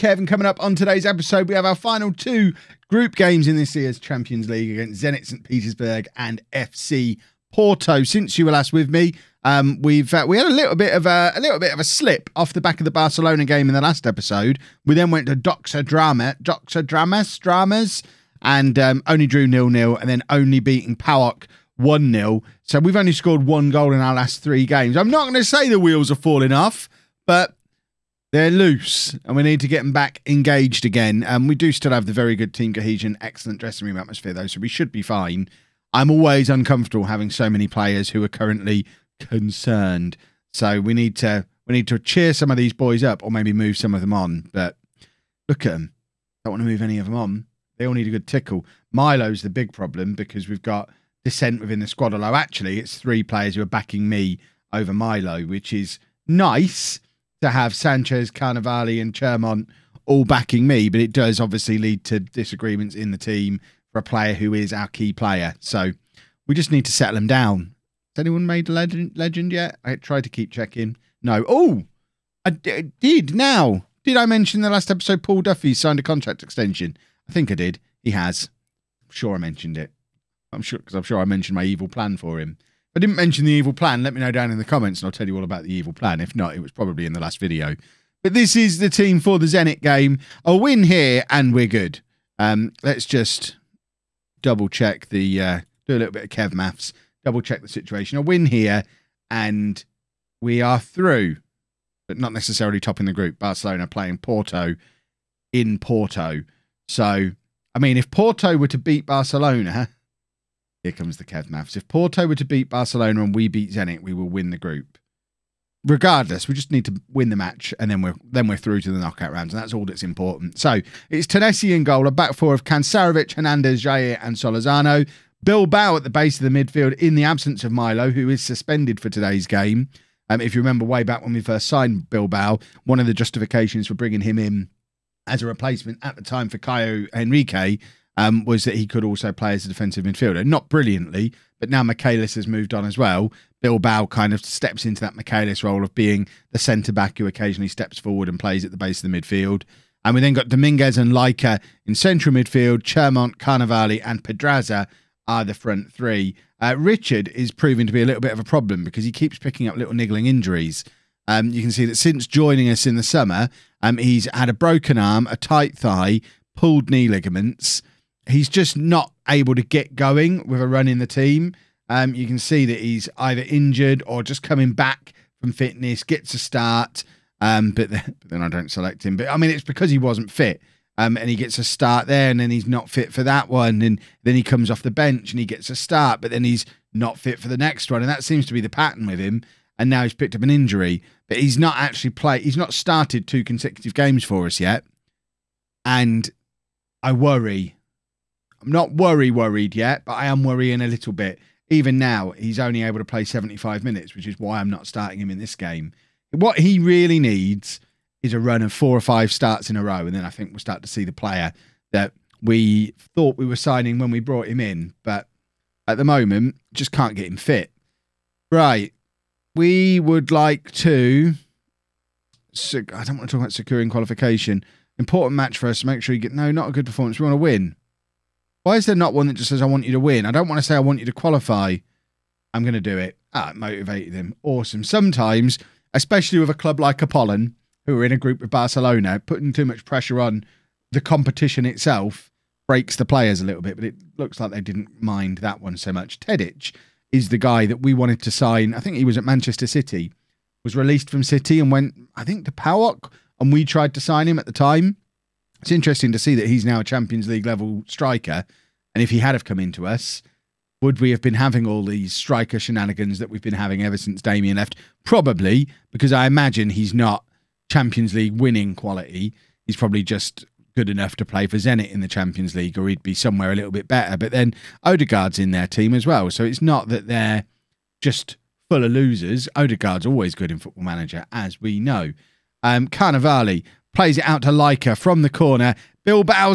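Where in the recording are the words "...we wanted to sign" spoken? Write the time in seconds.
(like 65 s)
247 s.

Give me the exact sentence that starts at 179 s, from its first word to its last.
But I mean, it's because he wasn't fit.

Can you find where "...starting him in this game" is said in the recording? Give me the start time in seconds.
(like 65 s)
204 s.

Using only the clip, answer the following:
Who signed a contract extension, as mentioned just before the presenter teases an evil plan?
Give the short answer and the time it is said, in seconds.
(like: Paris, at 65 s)
Paul Duffy, at 75 s.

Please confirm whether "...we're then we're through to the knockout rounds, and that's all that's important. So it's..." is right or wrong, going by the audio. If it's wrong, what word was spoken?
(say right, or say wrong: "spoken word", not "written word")
right.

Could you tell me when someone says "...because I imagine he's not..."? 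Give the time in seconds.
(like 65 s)
265 s.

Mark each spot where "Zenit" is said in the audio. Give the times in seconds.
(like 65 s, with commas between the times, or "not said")
5 s, 89 s, 113 s, 271 s.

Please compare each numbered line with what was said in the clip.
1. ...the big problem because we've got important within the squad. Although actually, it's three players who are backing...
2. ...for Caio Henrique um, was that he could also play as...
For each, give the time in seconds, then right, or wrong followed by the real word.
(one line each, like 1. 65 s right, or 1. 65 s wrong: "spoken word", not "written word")
1. 49 s wrong: "dissent", not "important"
2. 136 s right.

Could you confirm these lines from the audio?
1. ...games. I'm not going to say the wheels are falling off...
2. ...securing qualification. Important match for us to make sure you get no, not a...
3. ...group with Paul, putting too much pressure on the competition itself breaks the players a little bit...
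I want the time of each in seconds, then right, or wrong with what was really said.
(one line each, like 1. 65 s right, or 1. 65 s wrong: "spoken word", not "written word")
1. 24 s right
2. 223 s right
3. 238 s wrong: "Barcelona", not "Paul".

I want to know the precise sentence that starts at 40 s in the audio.
So we need to we need to cheer some of these boys up, or maybe move some of them on.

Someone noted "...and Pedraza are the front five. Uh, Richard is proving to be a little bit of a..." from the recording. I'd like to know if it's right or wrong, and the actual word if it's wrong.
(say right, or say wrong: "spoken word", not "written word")
wrong: "three", not "five".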